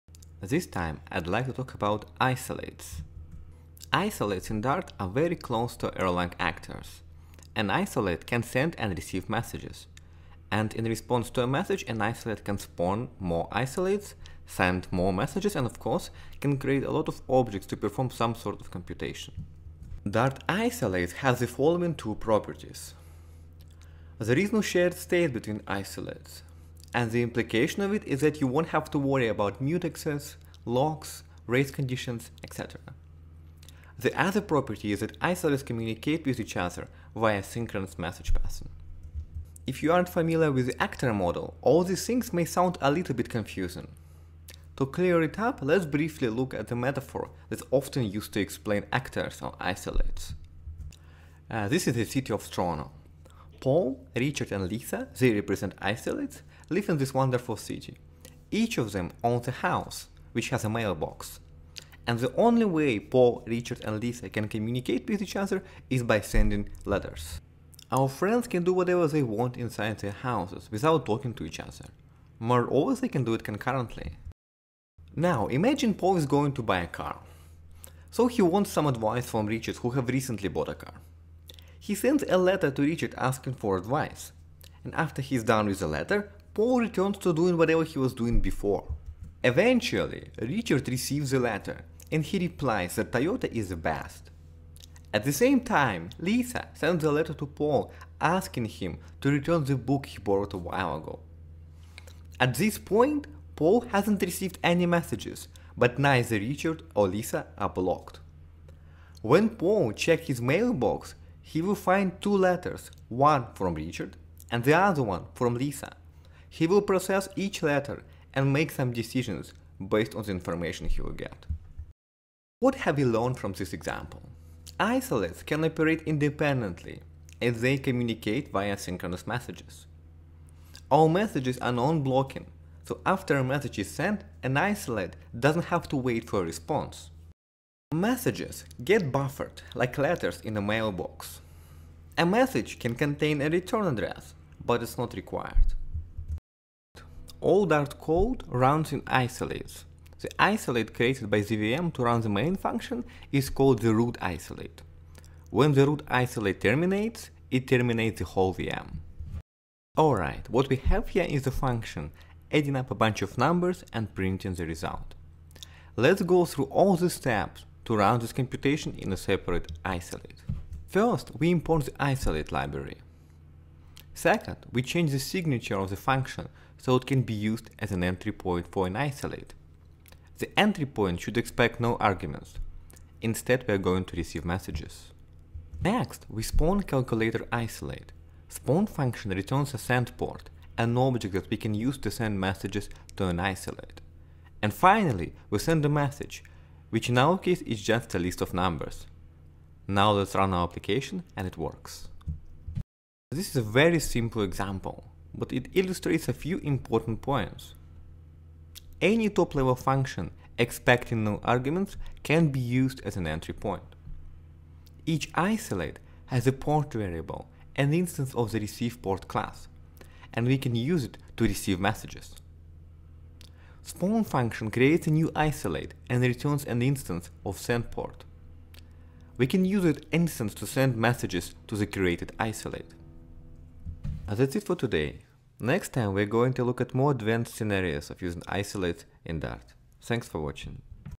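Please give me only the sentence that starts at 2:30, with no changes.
The isolate created by the VM to run the main function is called the root isolate.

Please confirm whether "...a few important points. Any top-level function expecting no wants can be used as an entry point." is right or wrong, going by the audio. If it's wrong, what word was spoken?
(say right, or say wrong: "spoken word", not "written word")
wrong: "arguments", not "wants".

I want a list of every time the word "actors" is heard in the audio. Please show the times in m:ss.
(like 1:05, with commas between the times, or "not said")
0:06, 0:40, 0:48.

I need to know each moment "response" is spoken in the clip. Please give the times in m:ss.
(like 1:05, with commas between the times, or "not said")
0:10, 2:16.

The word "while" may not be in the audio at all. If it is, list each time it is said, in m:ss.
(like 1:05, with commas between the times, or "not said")
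1:40.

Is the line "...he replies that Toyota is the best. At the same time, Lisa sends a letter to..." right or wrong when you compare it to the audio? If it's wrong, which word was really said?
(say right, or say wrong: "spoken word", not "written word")
right.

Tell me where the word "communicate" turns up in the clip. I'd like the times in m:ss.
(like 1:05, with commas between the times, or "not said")
0:35, 1:04, 2:07.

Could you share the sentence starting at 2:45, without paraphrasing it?
Let's go through all the steps to run this computation in a separate isolate.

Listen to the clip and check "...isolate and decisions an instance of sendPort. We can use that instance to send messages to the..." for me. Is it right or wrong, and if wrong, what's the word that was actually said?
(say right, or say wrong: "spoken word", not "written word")
wrong: "returns", not "decisions".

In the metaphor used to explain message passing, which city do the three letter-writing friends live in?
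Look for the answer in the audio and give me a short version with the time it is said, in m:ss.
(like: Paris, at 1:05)
Toronto, at 0:52.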